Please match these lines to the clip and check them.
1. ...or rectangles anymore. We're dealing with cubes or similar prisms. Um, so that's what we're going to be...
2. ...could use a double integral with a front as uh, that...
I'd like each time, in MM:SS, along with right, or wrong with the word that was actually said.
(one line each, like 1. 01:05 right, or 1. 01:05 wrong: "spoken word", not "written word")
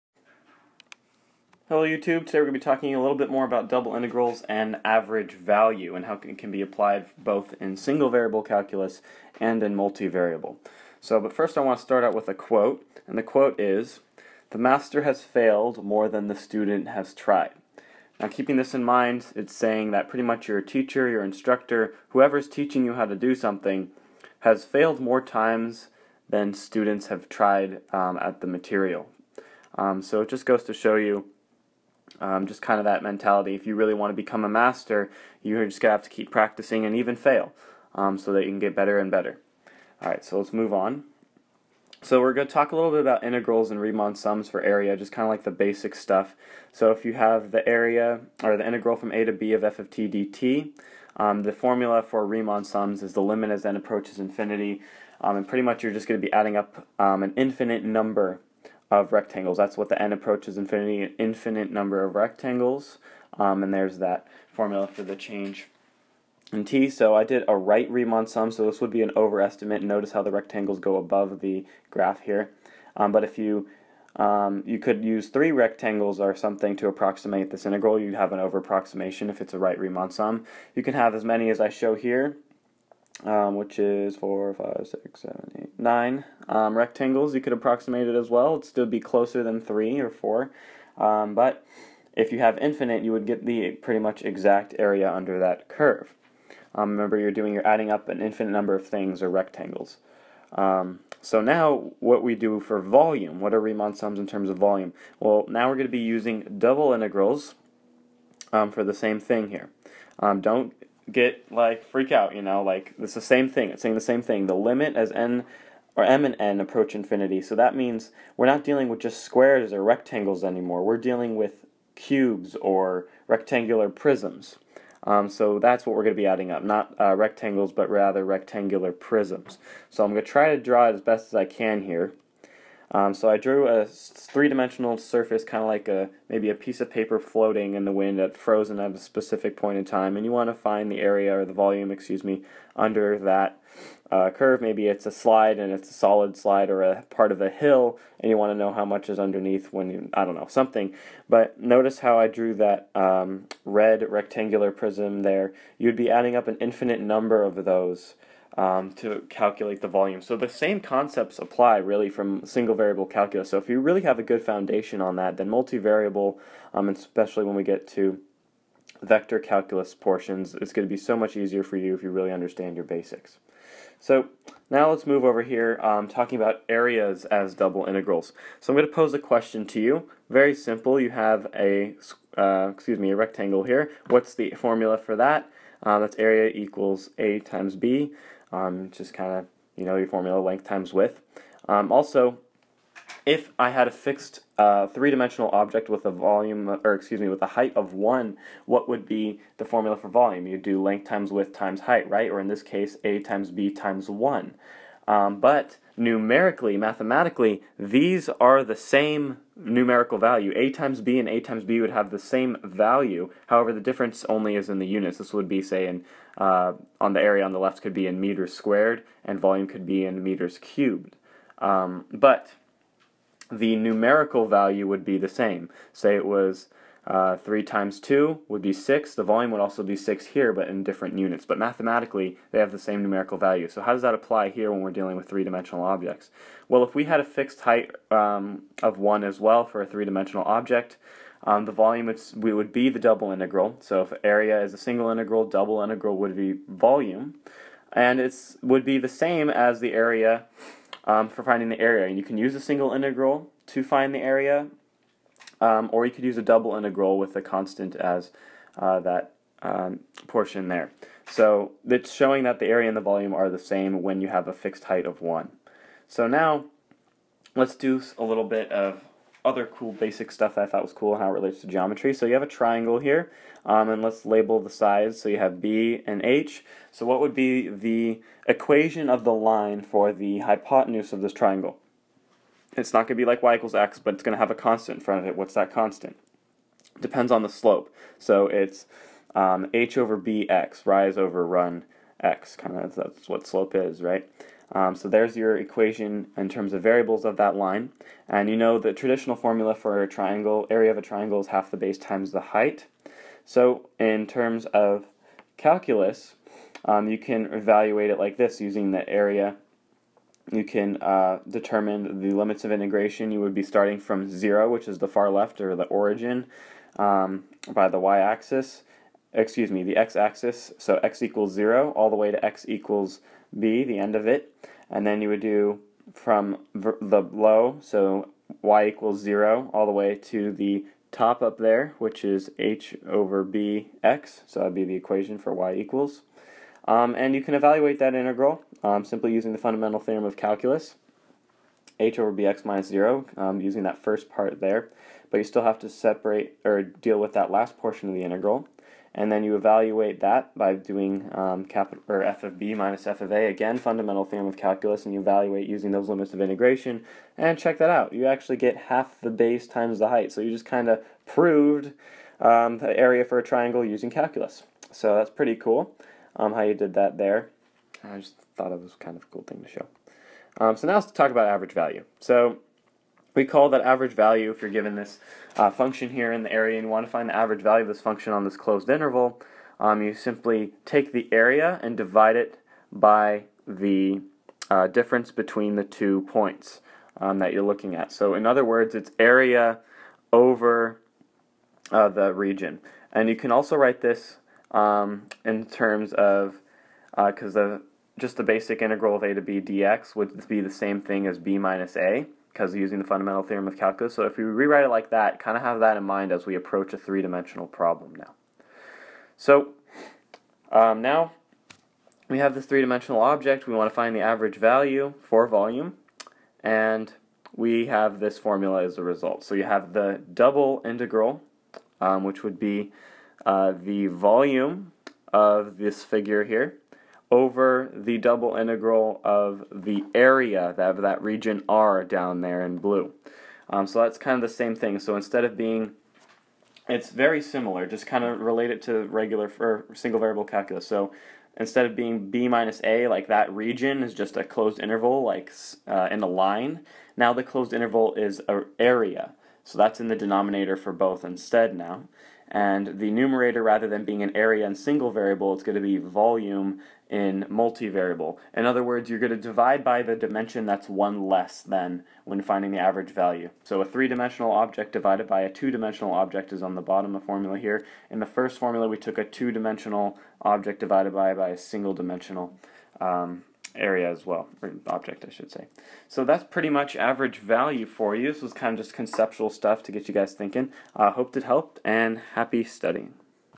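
1. 01:59 wrong: "rectangular", not "similar"
2. 04:16 wrong: "constant", not "front".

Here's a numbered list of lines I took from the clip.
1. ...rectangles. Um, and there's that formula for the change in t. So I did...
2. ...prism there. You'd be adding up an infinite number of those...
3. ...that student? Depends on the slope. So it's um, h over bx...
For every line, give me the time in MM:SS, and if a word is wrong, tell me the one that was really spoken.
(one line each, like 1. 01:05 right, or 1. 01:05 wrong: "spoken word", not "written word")
1. 01:02 right
2. 02:34 right
3. 04:45 wrong: "constant", not "student".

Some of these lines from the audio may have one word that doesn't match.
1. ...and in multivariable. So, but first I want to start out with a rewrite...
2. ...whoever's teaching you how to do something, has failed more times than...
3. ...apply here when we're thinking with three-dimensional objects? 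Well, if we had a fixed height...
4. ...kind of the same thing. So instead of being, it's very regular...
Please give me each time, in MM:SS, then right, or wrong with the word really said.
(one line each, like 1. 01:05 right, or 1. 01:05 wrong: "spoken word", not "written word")
1. 00:09 wrong: "quote", not "rewrite"
2. 00:22 right
3. 03:54 wrong: "dealing", not "thinking"
4. 07:14 wrong: "similar", not "regular".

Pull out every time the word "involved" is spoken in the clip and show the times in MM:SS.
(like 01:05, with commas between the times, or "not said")
not said.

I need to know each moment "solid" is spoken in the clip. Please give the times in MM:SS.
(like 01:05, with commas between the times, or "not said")
02:25.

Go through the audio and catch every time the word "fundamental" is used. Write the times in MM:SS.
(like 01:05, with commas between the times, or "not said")
05:39, 05:53, 06:43.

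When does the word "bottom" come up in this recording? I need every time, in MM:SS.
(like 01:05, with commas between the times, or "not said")
07:46.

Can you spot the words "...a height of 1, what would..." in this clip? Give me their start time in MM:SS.
03:17.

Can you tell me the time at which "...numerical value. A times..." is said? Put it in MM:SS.
03:29.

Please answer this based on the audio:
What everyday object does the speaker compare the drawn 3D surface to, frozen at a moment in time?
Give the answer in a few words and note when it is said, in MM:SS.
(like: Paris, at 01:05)
A piece of paper, at 02:16.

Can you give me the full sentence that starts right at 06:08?
I just thought it was kind of a cool thing to show.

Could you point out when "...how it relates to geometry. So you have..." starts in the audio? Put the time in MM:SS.
04:31.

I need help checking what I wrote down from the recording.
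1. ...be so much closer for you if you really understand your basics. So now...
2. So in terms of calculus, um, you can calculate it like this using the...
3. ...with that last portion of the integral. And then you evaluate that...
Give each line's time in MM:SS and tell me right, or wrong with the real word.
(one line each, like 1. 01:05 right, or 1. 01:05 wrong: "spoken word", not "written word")
1. 02:50 wrong: "easier", not "closer"
2. 05:03 wrong: "evaluate", not "calculate"
3. 05:47 right.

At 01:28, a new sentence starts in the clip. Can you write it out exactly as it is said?
It'd still be closer than three or four.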